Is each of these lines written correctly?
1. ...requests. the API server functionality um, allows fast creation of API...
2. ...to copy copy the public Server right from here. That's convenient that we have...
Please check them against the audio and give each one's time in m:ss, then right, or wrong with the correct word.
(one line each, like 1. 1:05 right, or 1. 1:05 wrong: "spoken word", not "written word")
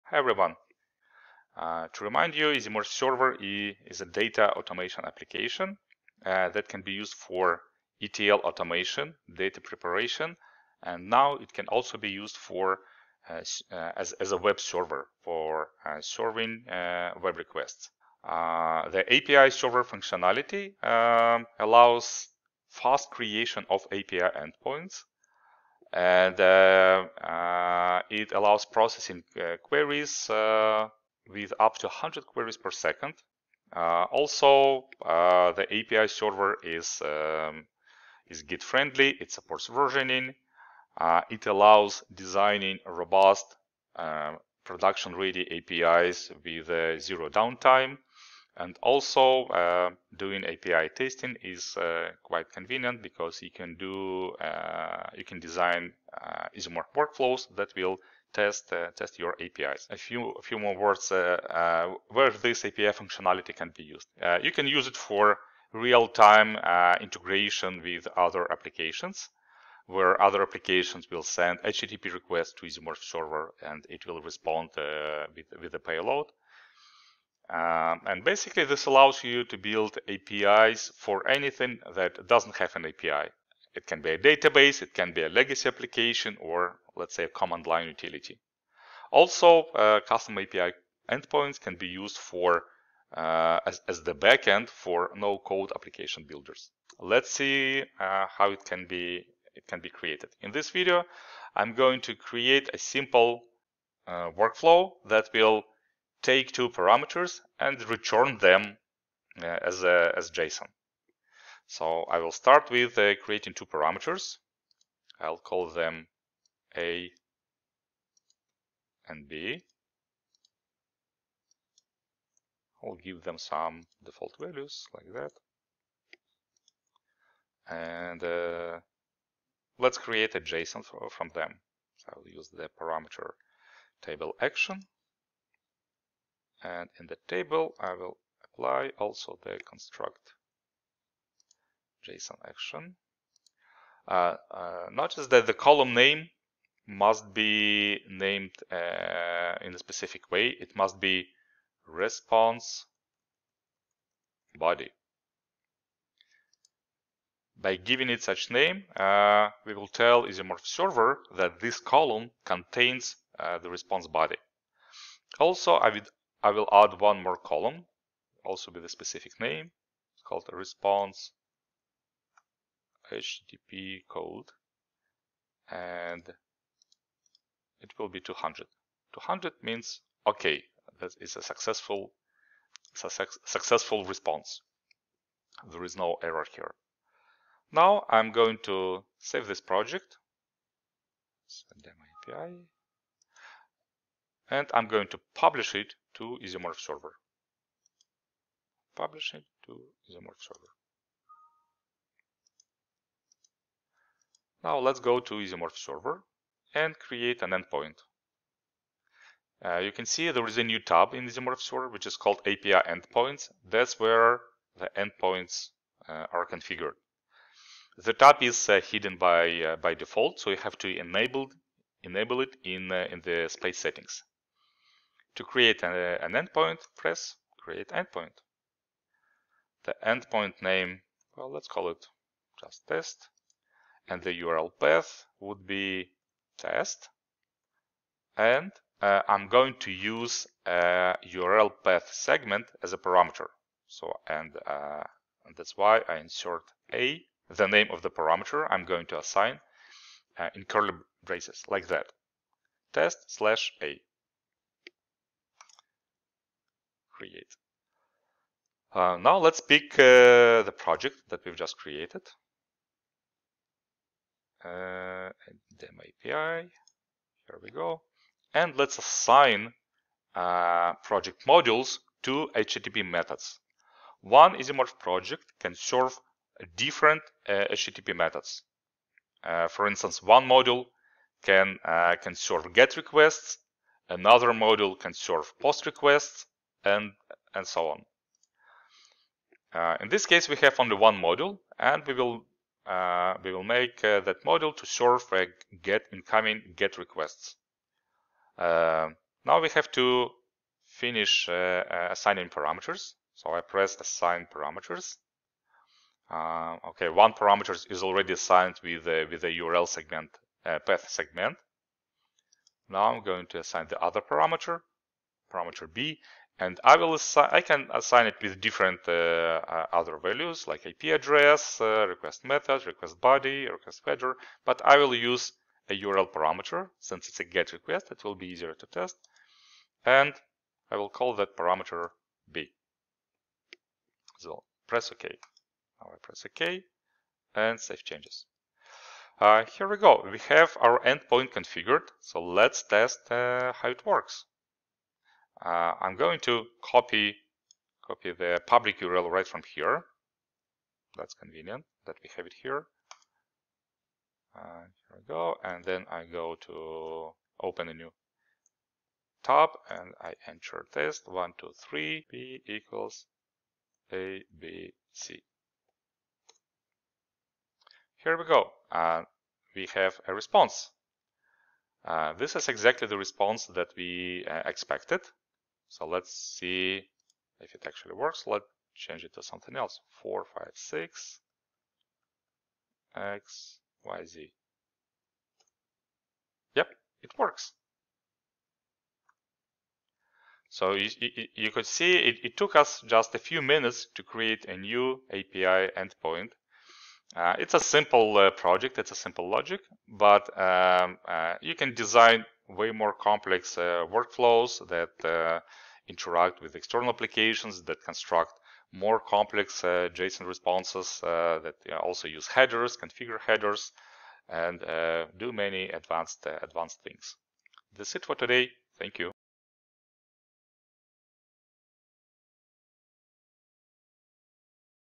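1. 0:17 right
2. 5:46 wrong: "URL", not "Server".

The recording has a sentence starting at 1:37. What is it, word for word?
Let's see uh, how it can be it can be created.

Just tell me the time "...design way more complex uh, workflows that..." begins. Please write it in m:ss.
6:41.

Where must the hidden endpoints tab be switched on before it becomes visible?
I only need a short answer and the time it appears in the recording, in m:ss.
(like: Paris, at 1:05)
space settings, at 3:43.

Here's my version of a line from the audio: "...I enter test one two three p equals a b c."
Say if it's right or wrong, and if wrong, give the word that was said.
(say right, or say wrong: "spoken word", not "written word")
right.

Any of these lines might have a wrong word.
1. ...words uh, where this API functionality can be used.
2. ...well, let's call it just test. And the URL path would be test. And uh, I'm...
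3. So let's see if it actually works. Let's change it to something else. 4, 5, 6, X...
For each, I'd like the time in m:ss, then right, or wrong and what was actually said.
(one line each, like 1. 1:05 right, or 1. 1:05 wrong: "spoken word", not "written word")
1. 1:00 right
2. 3:51 right
3. 6:15 right.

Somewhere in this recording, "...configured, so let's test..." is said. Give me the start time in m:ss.
5:41.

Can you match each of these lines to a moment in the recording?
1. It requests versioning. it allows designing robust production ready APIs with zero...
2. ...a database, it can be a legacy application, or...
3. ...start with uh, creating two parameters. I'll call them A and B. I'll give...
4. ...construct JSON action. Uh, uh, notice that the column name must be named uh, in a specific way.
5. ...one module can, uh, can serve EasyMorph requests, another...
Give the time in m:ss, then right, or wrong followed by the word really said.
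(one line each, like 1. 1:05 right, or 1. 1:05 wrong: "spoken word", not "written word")
1. 0:39 wrong: "supports", not "requests"
2. 1:24 right
3. 1:52 right
4. 2:19 right
5. 4:40 wrong: "GET", not "EasyMorph".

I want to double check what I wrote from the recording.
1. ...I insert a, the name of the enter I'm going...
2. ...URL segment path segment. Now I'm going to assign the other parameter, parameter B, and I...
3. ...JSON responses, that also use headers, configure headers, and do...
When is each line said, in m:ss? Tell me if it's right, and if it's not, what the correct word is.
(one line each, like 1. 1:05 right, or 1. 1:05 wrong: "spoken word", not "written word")
1. 4:06 wrong: "parameter", not "enter"
2. 5:09 right
3. 6:50 right.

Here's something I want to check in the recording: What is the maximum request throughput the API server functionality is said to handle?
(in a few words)
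100 queries per second.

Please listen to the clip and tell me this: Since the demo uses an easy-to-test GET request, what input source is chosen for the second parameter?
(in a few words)
URL parameter.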